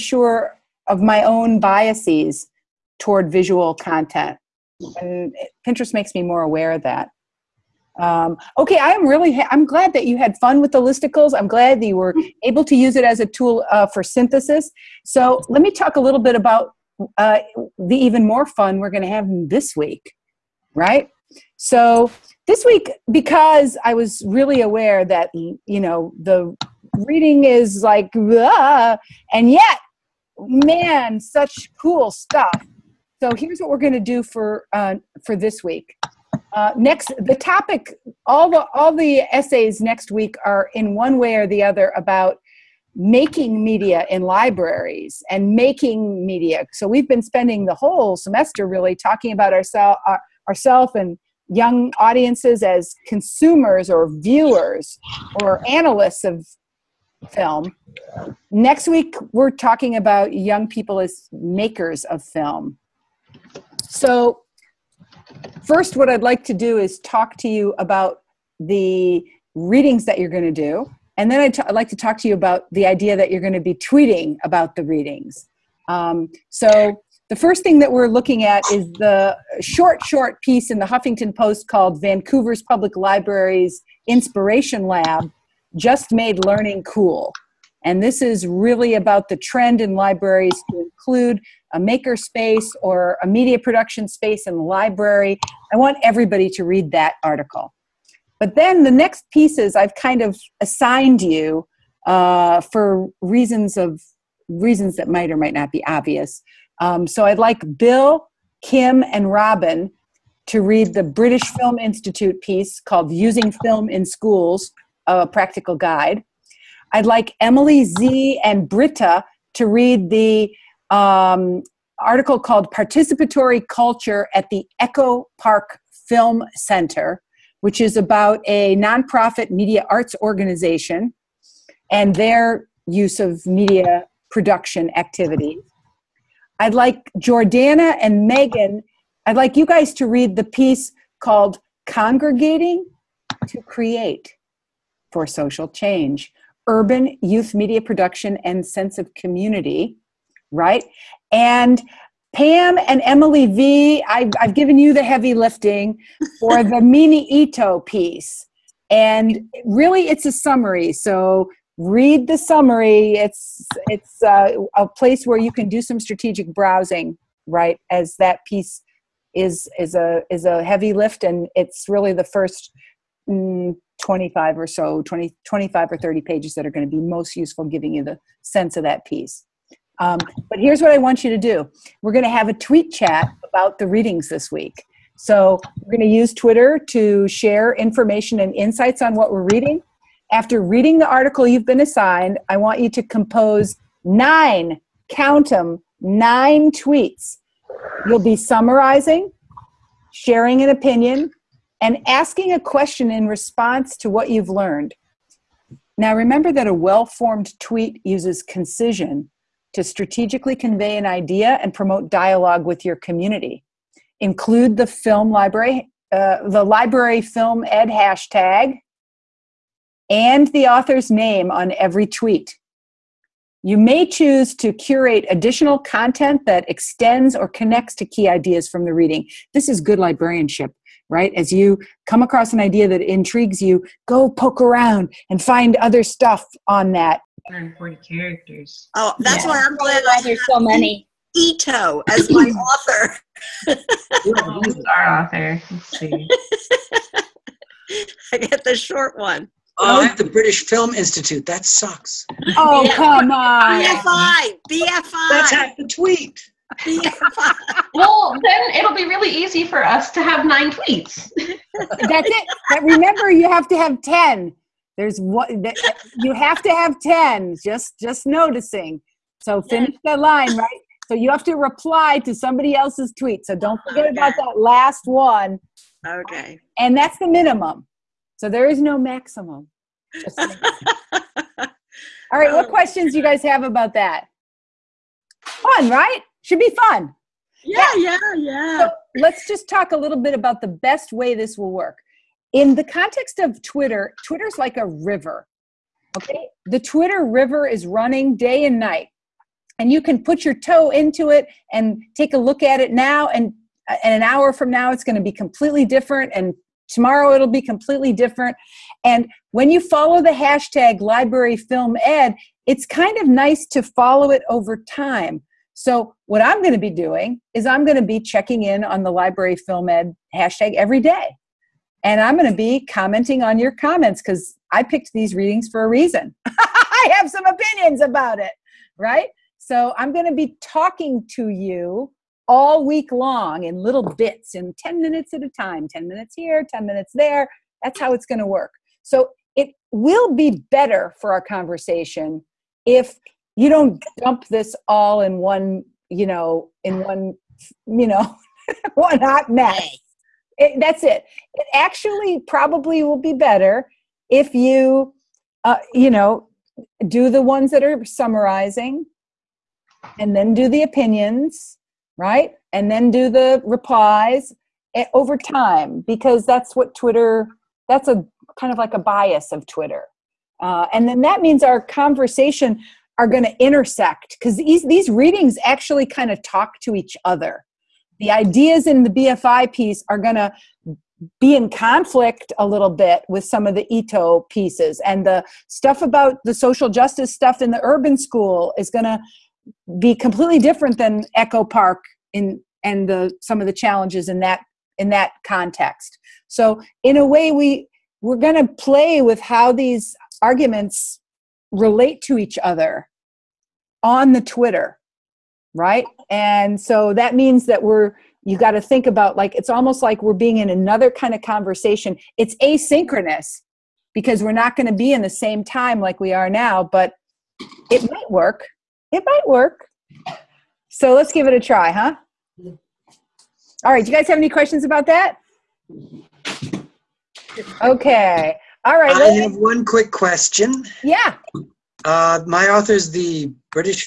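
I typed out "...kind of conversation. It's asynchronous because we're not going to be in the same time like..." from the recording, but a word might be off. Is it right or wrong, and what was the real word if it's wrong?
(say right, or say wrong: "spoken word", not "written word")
right.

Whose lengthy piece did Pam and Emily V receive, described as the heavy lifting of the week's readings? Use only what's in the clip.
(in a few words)
Mimi Ito.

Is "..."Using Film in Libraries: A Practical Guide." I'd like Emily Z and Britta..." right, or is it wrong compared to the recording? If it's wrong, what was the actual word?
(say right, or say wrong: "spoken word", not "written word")
wrong: "Schools", not "Libraries".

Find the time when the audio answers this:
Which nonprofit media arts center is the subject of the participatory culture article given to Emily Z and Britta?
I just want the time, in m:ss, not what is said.
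2:04.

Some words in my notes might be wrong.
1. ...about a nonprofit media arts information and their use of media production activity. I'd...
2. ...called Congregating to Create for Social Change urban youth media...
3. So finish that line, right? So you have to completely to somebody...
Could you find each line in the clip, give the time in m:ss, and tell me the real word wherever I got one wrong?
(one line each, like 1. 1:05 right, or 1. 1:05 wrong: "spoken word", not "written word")
1. 2:07 wrong: "organization", not "information"
2. 2:21 right
3. 4:29 wrong: "reply", not "completely".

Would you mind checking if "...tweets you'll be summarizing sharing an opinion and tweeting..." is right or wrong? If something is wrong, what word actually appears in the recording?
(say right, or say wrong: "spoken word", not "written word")
wrong: "asking", not "tweeting".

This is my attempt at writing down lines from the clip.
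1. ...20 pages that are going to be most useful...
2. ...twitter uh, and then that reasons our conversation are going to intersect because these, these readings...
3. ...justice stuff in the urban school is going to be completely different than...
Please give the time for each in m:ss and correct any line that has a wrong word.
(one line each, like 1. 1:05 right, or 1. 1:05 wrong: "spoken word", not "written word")
1. 2:55 wrong: "30", not "20"
2. 6:09 wrong: "means", not "reasons"
3. 6:26 right.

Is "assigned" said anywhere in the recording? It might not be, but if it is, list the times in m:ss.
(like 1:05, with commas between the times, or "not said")
1:40, 3:11.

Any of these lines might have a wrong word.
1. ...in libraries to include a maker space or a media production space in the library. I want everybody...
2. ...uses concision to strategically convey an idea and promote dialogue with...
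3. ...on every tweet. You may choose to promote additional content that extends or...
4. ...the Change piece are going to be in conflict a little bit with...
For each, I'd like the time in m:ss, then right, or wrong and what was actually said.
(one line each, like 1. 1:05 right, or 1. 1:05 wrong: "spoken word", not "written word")
1. 1:29 right
2. 3:28 right
3. 3:41 wrong: "curate", not "promote"
4. 6:19 wrong: "BFI", not "Change".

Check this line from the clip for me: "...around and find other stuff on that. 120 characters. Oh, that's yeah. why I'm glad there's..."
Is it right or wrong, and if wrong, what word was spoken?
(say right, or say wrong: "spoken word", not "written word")
wrong: "140", not "120".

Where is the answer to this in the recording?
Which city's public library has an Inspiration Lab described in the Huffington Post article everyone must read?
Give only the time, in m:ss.
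1:22.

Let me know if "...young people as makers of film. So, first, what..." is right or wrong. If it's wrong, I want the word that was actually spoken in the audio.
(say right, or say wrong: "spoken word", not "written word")
right.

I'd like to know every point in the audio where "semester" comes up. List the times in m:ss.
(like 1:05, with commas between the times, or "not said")
0:48.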